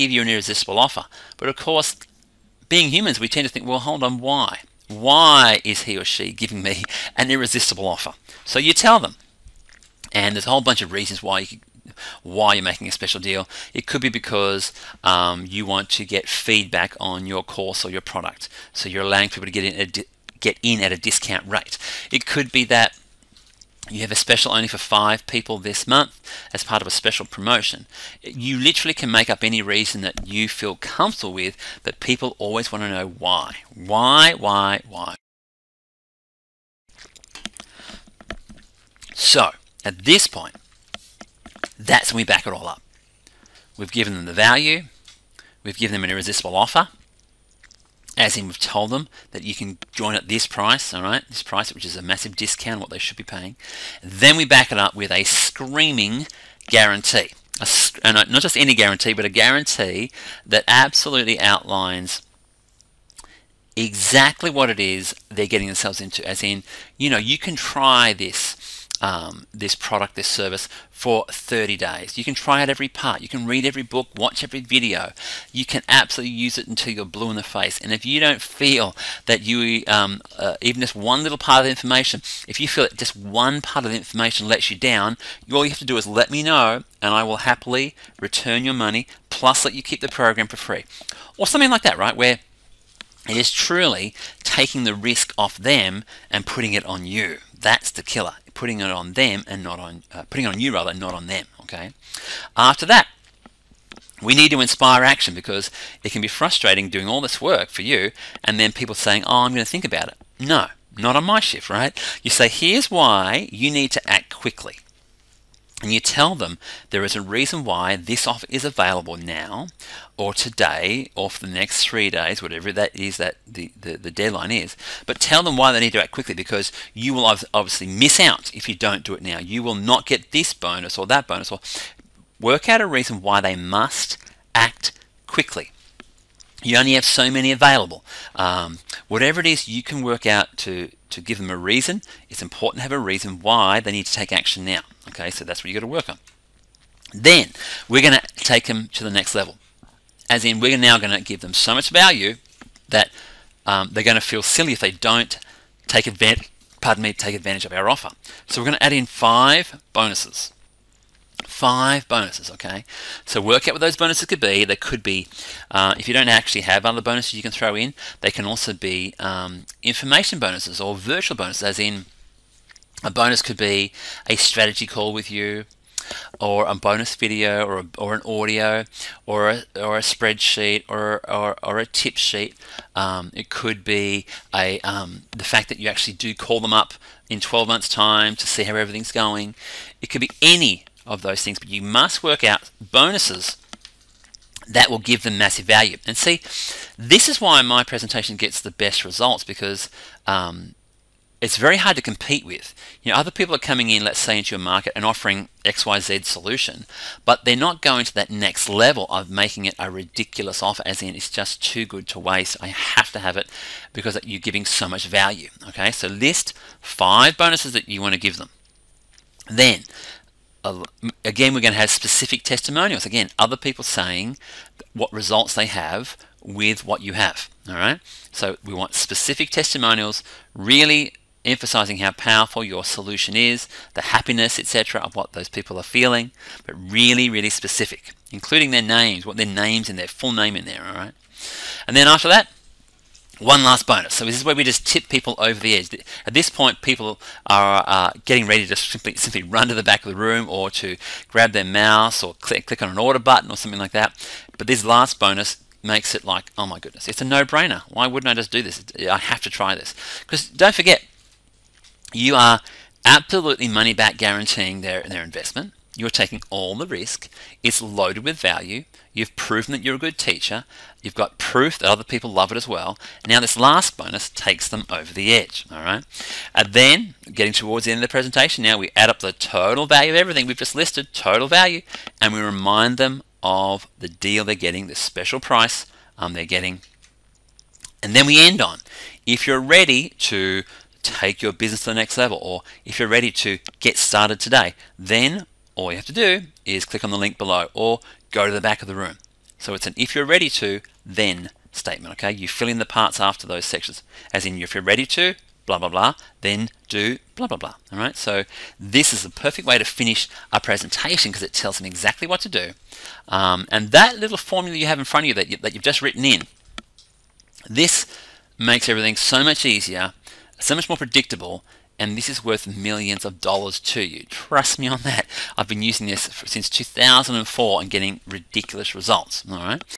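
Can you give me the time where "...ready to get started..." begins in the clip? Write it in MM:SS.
04:53.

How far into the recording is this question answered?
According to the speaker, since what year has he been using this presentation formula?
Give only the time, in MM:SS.
05:26.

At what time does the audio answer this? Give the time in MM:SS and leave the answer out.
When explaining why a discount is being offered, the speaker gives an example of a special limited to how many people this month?
00:24.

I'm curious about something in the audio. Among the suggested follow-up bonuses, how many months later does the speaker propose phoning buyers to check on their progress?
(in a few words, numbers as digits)
12.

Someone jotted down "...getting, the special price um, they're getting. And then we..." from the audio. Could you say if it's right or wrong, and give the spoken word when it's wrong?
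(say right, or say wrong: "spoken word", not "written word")
right.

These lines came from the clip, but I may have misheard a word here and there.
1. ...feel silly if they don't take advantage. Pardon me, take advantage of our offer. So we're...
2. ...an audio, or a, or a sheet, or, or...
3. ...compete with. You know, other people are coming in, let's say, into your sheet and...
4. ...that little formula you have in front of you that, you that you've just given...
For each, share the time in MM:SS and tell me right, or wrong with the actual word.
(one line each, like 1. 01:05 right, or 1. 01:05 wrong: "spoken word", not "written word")
1. 02:34 right
2. 02:58 wrong: "spreadsheet", not "sheet"
3. 03:22 wrong: "market", not "sheet"
4. 05:13 wrong: "written", not "given".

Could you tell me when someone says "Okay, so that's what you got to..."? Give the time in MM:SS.
02:25.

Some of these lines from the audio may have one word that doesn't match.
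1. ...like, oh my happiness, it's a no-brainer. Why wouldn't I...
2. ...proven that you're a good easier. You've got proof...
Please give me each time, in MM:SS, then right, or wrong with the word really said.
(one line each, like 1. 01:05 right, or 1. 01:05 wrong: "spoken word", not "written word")
1. 04:16 wrong: "goodness", not "happiness"
2. 04:29 wrong: "teacher", not "easier".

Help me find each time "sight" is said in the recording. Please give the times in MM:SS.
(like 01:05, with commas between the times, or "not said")
not said.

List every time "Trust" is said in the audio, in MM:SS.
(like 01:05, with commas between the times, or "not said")
05:24.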